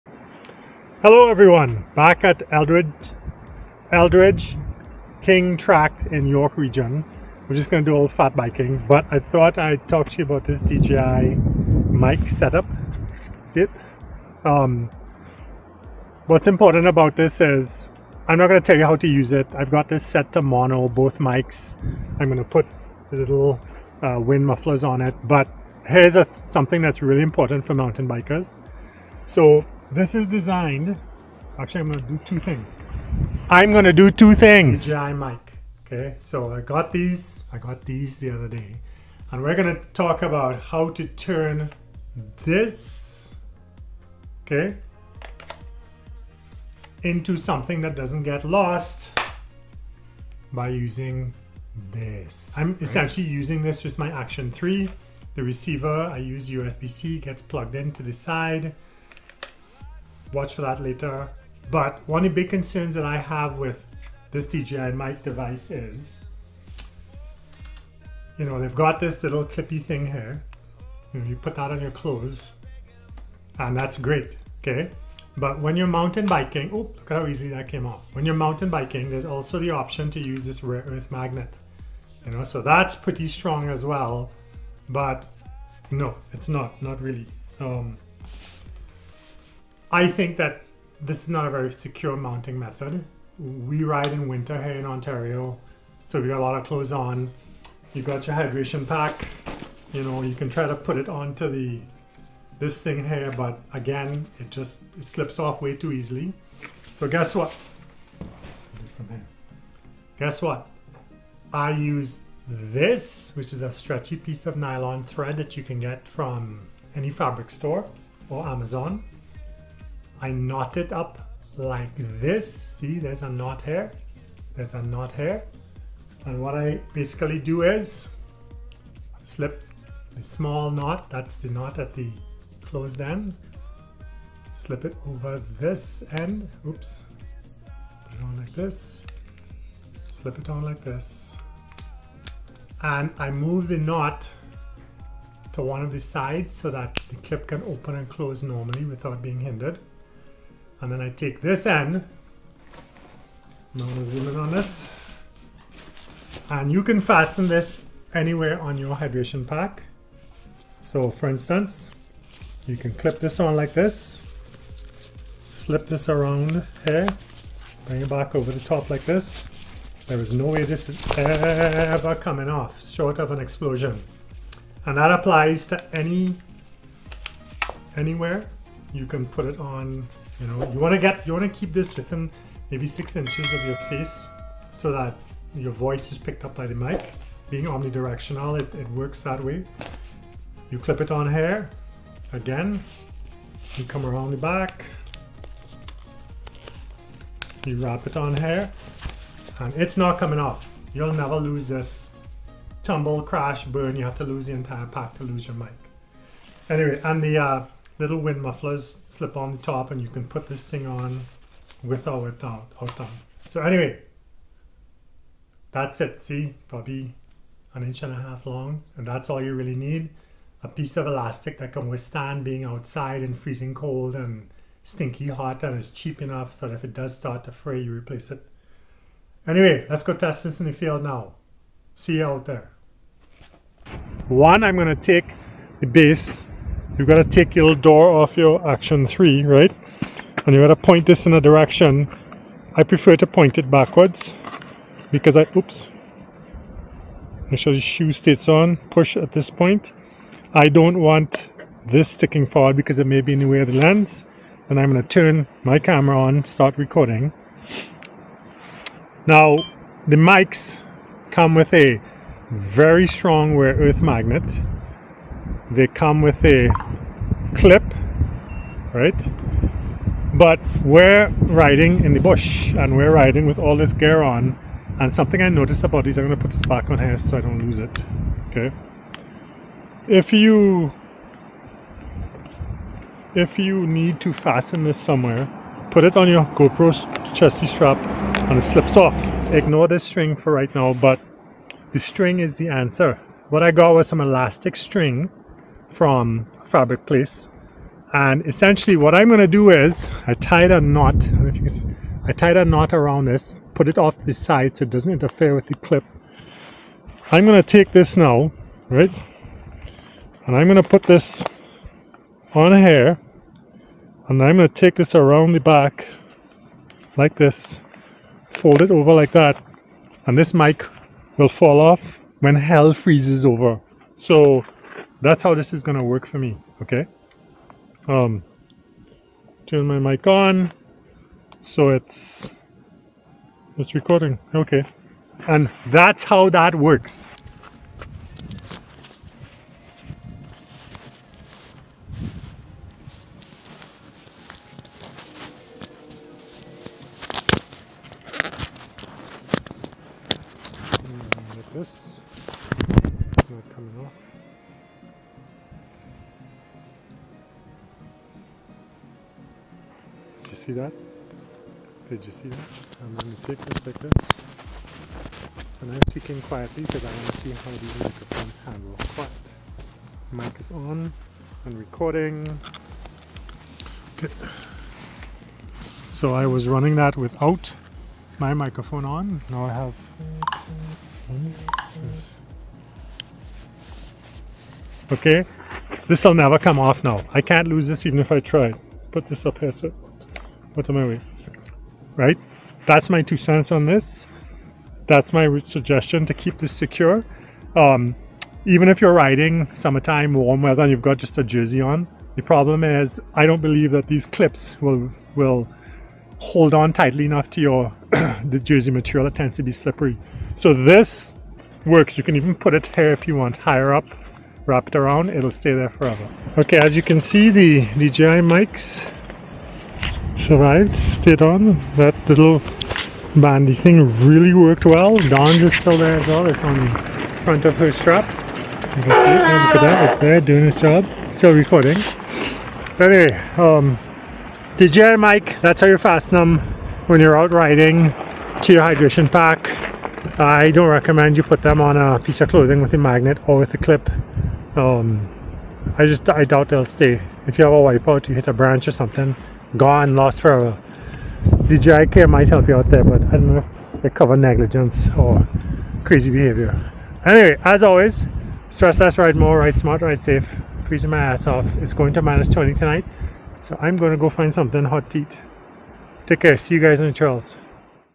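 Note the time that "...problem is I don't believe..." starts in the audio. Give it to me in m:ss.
6:42.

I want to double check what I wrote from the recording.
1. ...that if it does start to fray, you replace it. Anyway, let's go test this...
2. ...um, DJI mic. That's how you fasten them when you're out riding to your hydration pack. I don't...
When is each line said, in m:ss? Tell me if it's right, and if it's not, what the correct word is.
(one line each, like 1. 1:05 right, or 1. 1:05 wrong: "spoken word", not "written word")
1. 3:46 right
2. 7:13 right.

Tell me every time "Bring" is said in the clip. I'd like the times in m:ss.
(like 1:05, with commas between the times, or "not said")
2:47.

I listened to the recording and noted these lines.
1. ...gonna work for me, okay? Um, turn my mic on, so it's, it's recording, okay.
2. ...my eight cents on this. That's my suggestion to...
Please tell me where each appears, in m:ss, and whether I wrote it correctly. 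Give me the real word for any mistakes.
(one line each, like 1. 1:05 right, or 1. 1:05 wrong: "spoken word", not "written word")
1. 5:25 right
2. 6:33 wrong: "two", not "eight".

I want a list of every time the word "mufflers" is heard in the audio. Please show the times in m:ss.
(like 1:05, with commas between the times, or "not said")
0:24, 3:28.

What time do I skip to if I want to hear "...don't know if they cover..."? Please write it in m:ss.
7:33.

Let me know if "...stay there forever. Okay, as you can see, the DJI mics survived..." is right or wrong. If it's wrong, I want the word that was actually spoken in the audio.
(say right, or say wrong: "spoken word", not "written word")
right.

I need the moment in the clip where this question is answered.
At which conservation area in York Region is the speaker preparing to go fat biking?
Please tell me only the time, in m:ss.
0:03.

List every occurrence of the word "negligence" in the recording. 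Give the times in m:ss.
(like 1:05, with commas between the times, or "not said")
7:34.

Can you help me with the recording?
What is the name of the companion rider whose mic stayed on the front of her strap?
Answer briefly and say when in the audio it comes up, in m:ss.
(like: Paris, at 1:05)
Don, at 7:05.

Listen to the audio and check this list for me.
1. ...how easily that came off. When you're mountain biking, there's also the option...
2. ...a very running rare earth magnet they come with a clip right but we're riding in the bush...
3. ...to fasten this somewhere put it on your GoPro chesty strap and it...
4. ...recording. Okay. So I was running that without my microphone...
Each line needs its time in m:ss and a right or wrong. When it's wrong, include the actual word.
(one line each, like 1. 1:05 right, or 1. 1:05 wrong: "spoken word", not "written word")
1. 1:17 right
2. 4:21 wrong: "strong", not "running"
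3. 4:44 right
4. 6:11 right.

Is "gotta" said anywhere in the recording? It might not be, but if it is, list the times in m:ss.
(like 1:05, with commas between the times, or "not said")
not said.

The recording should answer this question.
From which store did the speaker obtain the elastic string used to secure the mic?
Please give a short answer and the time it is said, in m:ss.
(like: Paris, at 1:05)
Fabric Place, at 4:56.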